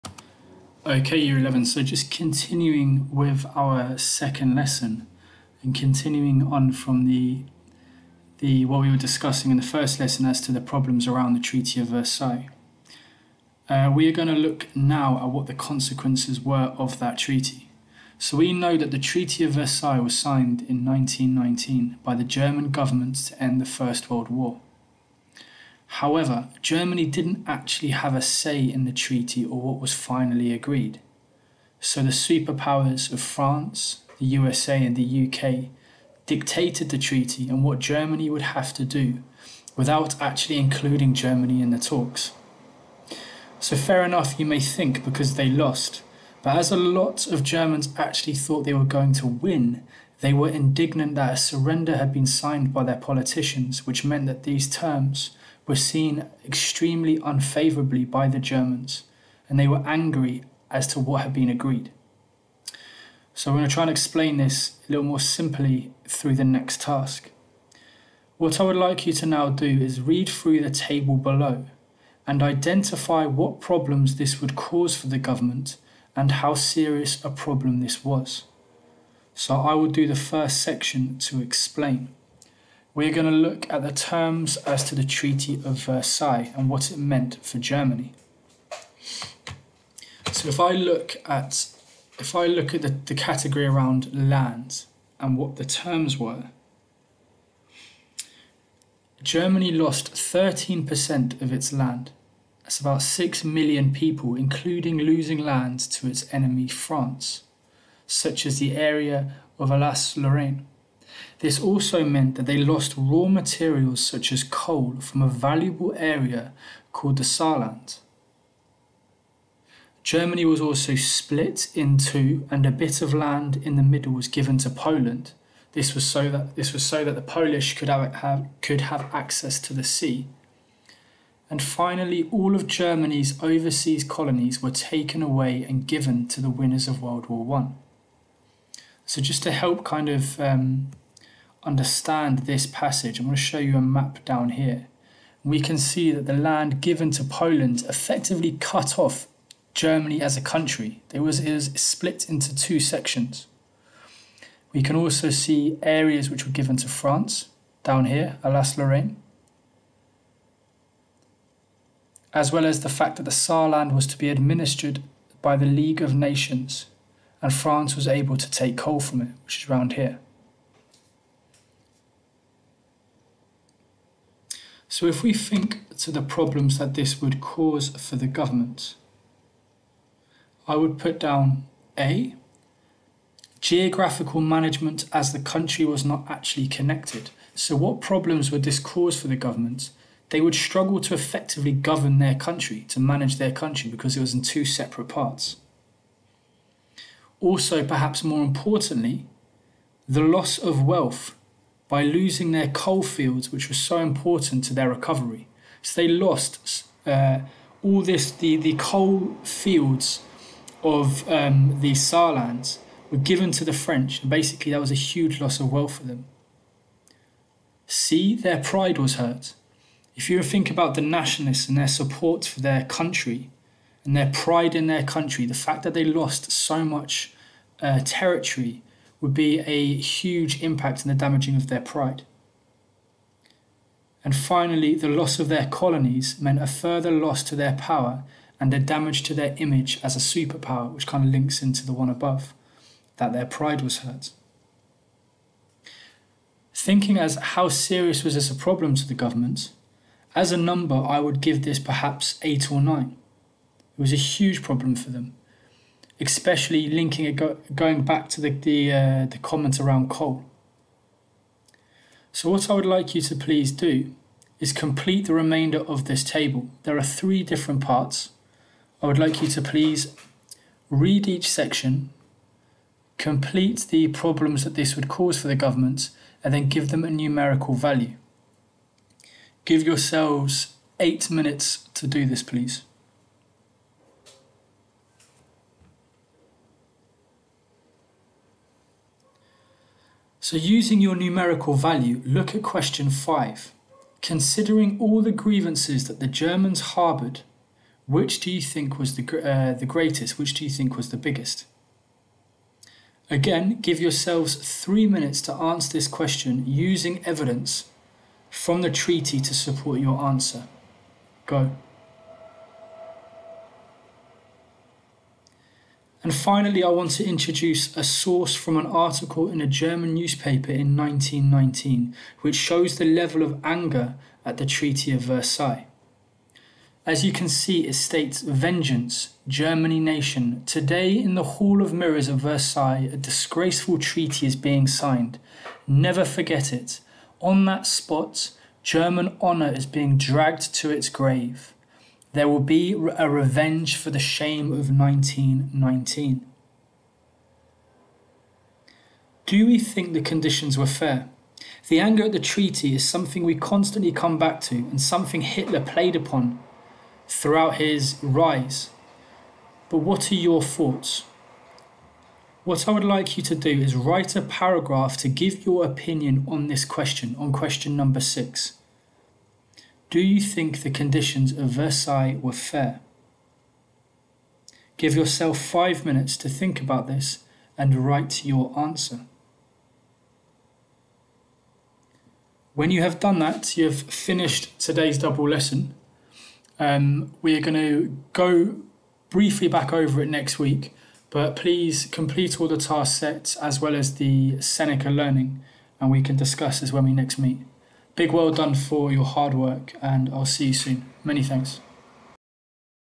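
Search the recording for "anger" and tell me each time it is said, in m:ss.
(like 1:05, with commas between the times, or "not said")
5:23, 5:51.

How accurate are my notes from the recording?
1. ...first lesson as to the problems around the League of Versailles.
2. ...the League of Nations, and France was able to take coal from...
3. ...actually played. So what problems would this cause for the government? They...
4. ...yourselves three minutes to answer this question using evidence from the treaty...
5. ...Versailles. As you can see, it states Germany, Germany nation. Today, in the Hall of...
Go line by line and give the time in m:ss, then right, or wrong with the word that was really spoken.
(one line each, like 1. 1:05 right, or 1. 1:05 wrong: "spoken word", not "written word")
1. 0:09 wrong: "Treaty", not "League"
2. 2:45 right
3. 3:06 wrong: "connected", not "played"
4. 5:04 right
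5. 5:25 wrong: "Vengeance", not "Germany".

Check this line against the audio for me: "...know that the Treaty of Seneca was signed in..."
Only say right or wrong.
wrong.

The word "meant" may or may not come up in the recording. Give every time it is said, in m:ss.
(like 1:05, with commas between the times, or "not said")
0:54, 1:26, 1:52, 3:56.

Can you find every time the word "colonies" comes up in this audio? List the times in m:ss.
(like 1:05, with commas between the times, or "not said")
2:14, 3:55.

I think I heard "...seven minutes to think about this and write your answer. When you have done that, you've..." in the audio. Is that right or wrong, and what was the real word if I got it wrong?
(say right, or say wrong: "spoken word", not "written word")
wrong: "five", not "seven".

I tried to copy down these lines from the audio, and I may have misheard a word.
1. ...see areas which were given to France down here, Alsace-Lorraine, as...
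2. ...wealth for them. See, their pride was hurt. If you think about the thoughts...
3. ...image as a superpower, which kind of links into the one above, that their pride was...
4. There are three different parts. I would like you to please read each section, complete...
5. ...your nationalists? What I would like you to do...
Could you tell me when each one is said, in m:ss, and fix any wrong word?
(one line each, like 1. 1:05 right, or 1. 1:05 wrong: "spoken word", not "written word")
1. 2:35 right
2. 3:35 wrong: "nationalists", not "thoughts"
3. 3:59 right
4. 4:26 right
5. 6:00 wrong: "thoughts", not "nationalists".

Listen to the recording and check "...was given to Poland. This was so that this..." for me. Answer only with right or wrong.
right.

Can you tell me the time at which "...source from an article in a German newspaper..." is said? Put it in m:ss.
5:18.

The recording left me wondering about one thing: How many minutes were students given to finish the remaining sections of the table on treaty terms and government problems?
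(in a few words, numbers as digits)
8.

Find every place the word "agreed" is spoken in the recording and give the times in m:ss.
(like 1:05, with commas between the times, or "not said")
0:30, 1:01.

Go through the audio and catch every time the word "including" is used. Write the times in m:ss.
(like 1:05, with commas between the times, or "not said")
0:40, 1:44.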